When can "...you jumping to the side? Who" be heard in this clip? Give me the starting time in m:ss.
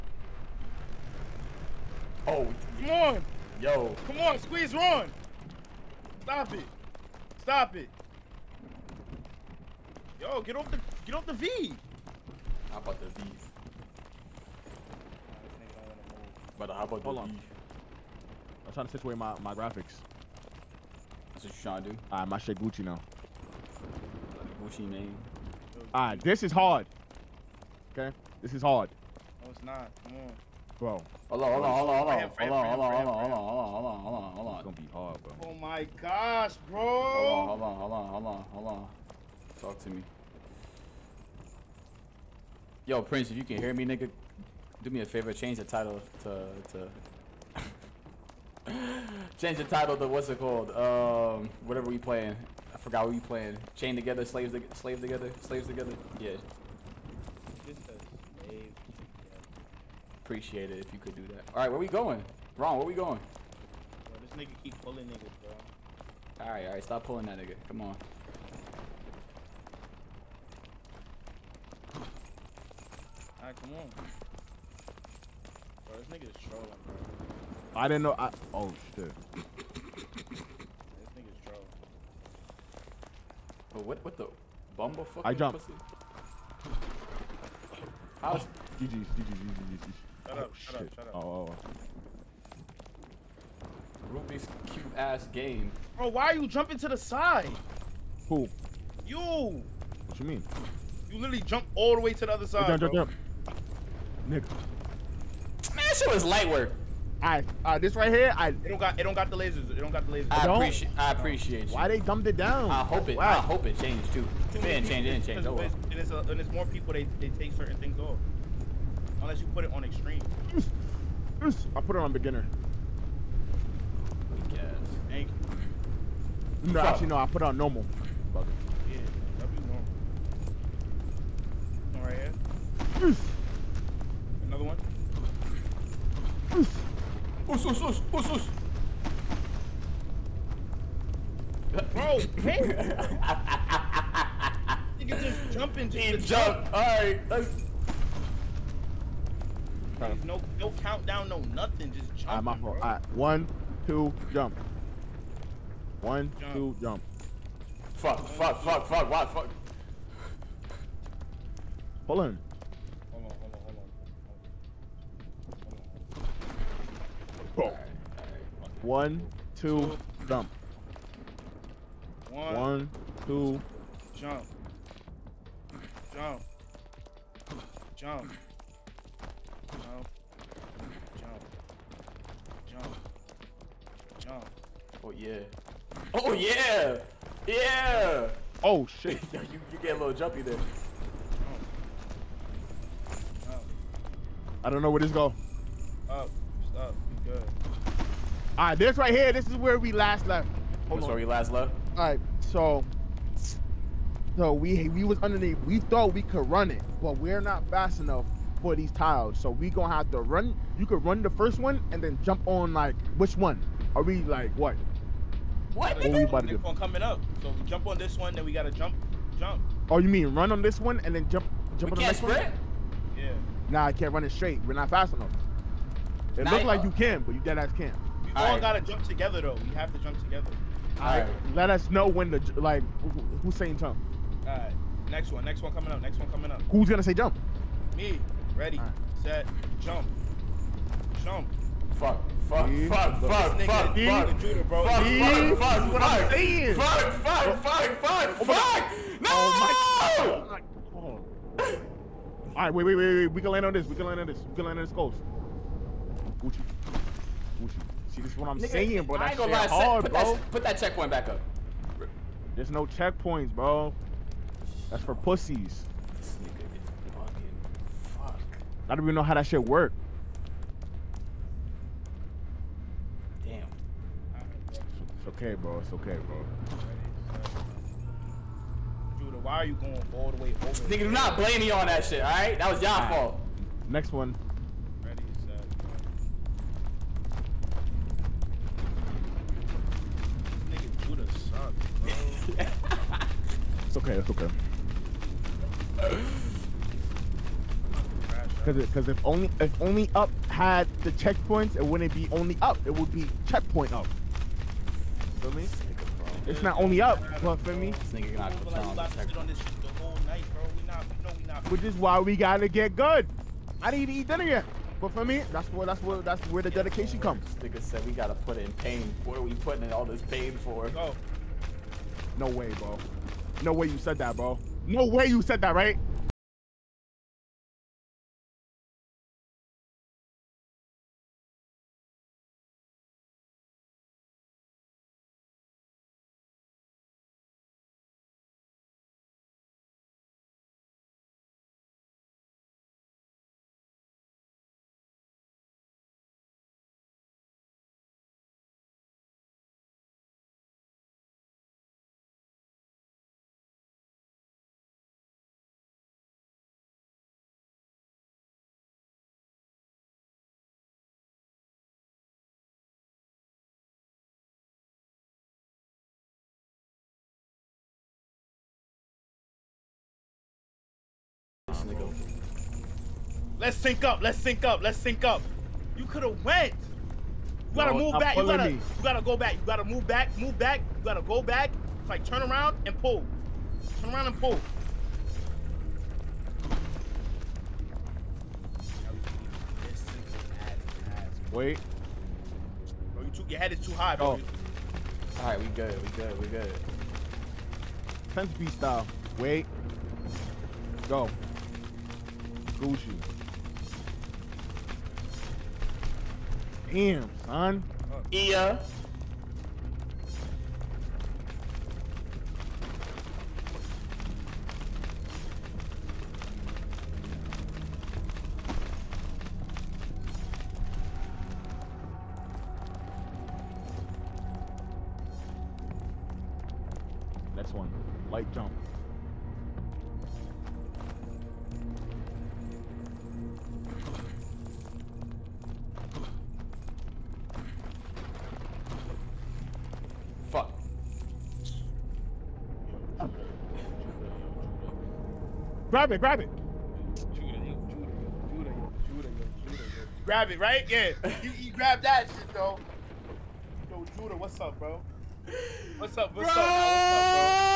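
1:36.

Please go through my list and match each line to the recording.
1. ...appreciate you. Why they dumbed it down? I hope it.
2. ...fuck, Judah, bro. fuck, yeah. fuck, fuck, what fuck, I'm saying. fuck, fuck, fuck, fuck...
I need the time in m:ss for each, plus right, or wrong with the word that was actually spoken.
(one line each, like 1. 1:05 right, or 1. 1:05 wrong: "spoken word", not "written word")
1. 1:51 right
2. 4:04 right.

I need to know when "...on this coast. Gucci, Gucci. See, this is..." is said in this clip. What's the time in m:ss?
4:14.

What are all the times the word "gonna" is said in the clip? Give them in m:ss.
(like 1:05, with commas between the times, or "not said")
0:34, 3:29, 3:56, 4:19.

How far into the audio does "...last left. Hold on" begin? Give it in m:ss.
3:19.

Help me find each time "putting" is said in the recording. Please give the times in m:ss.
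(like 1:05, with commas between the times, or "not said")
5:19.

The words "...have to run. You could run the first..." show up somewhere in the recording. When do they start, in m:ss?
3:29.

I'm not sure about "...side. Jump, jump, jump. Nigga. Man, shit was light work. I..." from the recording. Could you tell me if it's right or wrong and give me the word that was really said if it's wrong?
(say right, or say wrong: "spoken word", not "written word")
right.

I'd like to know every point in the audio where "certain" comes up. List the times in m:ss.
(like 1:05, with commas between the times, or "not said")
1:57.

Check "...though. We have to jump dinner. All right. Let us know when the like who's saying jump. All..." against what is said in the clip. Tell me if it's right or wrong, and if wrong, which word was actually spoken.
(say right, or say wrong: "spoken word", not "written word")
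wrong: "together", not "dinner".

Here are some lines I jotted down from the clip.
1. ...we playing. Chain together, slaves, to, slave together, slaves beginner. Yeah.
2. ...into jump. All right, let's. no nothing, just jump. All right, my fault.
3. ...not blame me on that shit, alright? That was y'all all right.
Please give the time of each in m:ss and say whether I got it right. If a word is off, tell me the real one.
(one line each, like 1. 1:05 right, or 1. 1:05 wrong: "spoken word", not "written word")
1. 0:53 wrong: "together", not "beginner"
2. 2:25 right
3. 4:41 right.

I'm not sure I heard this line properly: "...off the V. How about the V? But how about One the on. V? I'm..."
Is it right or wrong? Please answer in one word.
wrong.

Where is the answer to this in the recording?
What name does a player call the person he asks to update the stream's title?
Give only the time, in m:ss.
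0:43.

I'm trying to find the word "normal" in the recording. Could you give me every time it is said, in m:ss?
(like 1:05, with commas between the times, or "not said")
2:07, 2:11.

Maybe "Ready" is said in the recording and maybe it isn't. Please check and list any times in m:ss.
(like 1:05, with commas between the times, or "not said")
3:58, 4:45.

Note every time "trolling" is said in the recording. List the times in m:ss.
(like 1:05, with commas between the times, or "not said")
1:16, 1:21.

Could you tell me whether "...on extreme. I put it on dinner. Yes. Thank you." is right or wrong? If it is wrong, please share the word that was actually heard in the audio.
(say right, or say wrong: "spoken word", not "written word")
wrong: "beginner", not "dinner".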